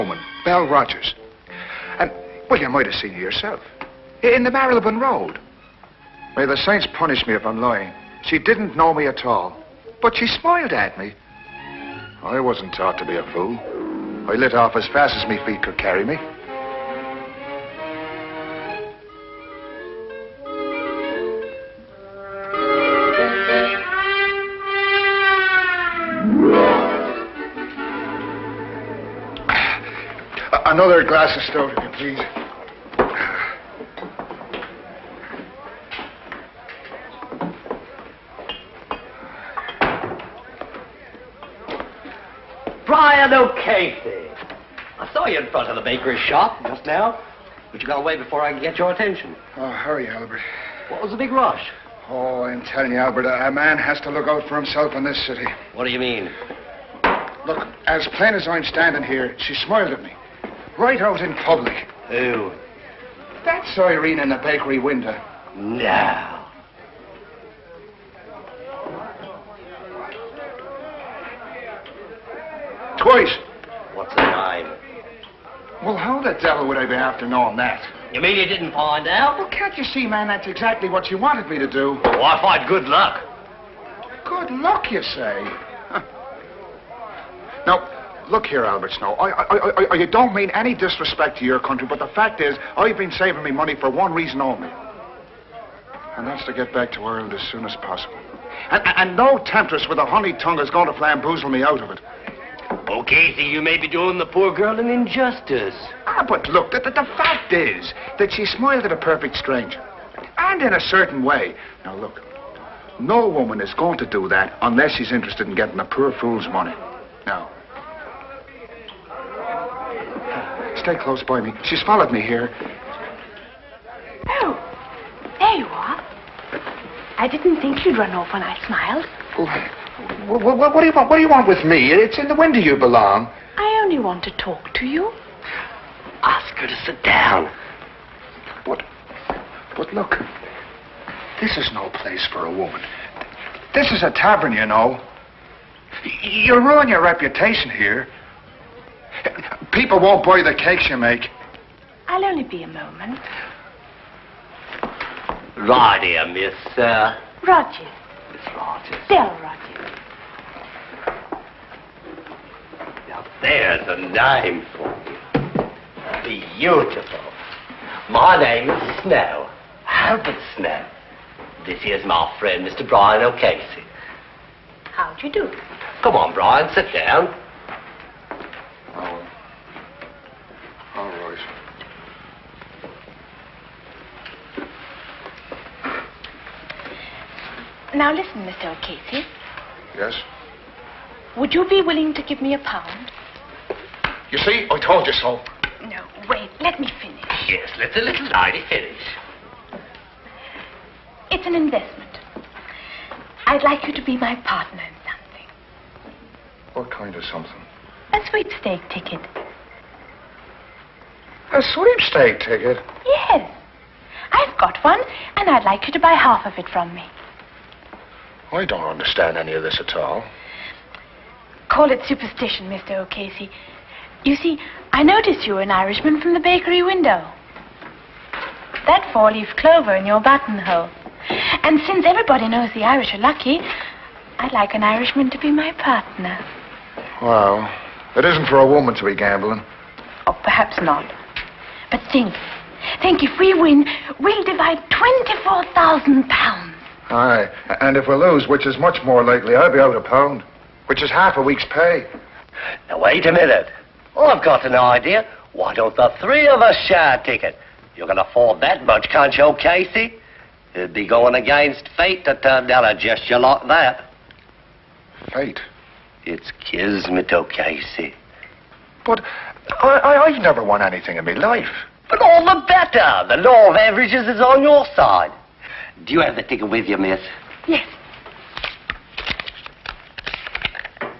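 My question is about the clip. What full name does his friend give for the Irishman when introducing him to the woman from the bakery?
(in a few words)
Brian O'Casey.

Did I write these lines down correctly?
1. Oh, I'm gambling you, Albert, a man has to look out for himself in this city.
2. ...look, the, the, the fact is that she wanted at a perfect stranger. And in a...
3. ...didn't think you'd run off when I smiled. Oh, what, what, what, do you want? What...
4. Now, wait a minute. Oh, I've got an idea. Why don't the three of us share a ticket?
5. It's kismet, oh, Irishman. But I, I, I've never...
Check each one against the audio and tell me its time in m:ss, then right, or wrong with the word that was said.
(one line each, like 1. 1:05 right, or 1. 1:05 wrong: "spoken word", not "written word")
1. 0:52 wrong: "telling", not "gambling"
2. 1:46 wrong: "smiled", not "wanted"
3. 2:07 right
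4. 4:12 right
5. 4:26 wrong: "Casey", not "Irishman".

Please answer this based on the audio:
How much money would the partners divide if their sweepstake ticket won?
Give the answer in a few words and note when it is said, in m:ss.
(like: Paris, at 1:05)
24,000 pounds, at 4:04.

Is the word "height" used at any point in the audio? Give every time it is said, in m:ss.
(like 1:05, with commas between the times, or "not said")
not said.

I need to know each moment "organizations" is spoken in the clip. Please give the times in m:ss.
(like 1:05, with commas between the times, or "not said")
not said.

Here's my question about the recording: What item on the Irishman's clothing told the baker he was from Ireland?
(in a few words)
four-leaf clover.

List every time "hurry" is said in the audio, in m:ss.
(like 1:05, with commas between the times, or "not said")
0:49.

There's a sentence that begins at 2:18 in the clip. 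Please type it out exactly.
But, but look, this is no place for a woman.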